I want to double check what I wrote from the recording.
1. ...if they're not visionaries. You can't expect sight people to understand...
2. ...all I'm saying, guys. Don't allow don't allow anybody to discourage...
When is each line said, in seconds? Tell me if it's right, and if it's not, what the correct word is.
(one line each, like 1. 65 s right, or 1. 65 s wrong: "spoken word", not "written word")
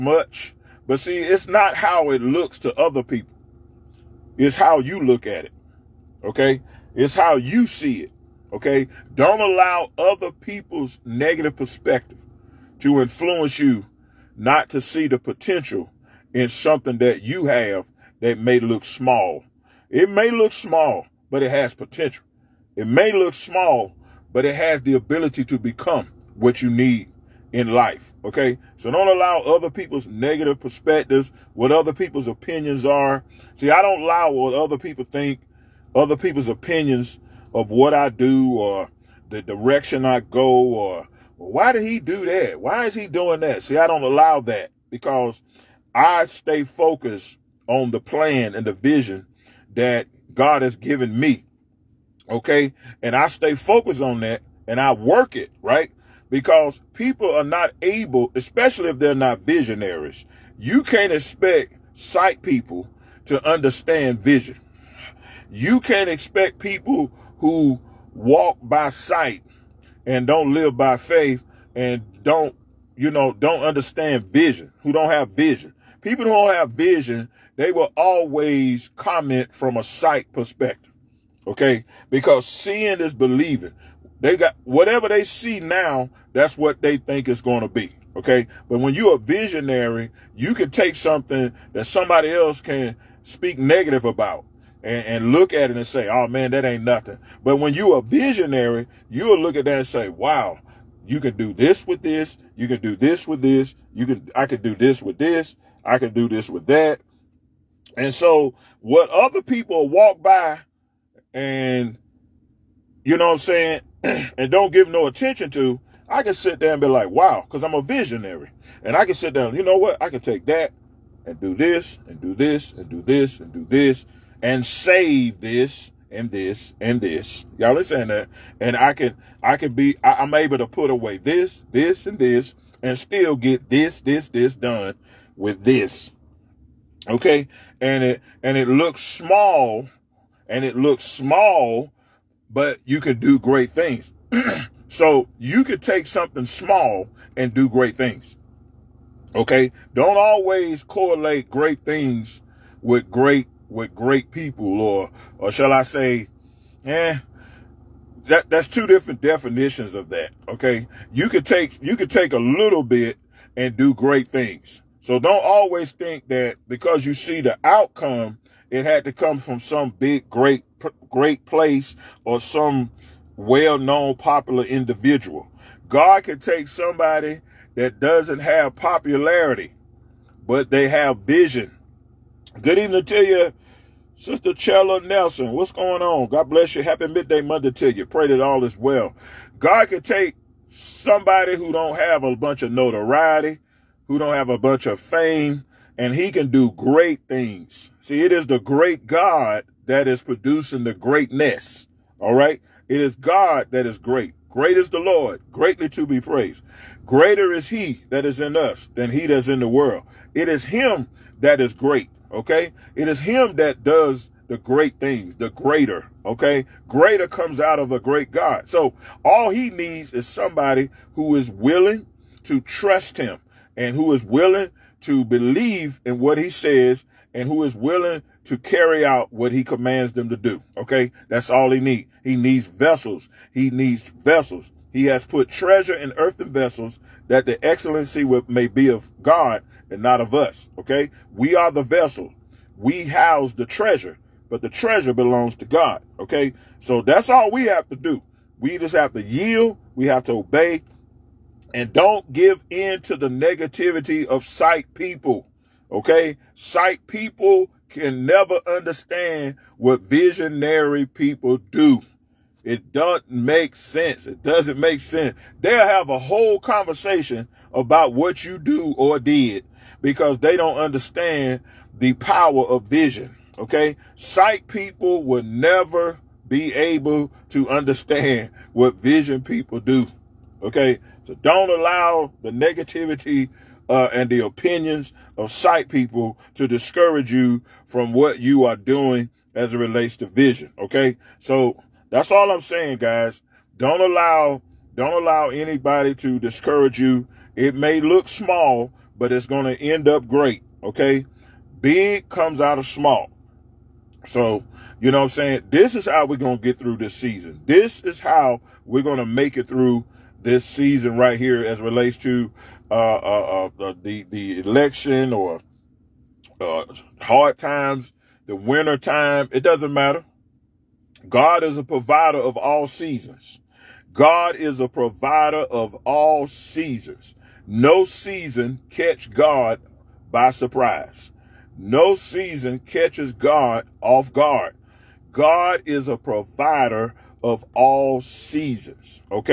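1. 58 s right
2. 292 s right.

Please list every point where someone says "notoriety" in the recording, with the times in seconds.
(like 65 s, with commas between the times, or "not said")
192 s.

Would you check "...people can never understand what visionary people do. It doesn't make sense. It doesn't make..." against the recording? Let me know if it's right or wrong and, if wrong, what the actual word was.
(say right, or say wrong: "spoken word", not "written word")
right.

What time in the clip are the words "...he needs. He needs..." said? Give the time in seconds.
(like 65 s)
231 s.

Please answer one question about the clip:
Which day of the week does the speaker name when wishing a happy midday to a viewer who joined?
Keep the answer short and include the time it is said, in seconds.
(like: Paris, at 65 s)
Monday, at 187 s.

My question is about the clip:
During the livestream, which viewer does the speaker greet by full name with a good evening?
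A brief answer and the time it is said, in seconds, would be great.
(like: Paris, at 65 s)
Chella Nelson, at 184 s.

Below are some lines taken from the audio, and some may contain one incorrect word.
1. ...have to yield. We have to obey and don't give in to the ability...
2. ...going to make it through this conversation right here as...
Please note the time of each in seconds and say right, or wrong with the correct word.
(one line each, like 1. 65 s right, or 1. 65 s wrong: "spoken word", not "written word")
1. 248 s wrong: "negativity", not "ability"
2. 309 s wrong: "season", not "conversation".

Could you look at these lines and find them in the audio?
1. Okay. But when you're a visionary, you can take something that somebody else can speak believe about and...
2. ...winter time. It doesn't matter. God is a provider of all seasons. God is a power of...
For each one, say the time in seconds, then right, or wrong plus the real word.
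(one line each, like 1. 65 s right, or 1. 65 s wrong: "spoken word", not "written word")
1. 88 s wrong: "negative", not "believe"
2. 318 s wrong: "provider", not "power".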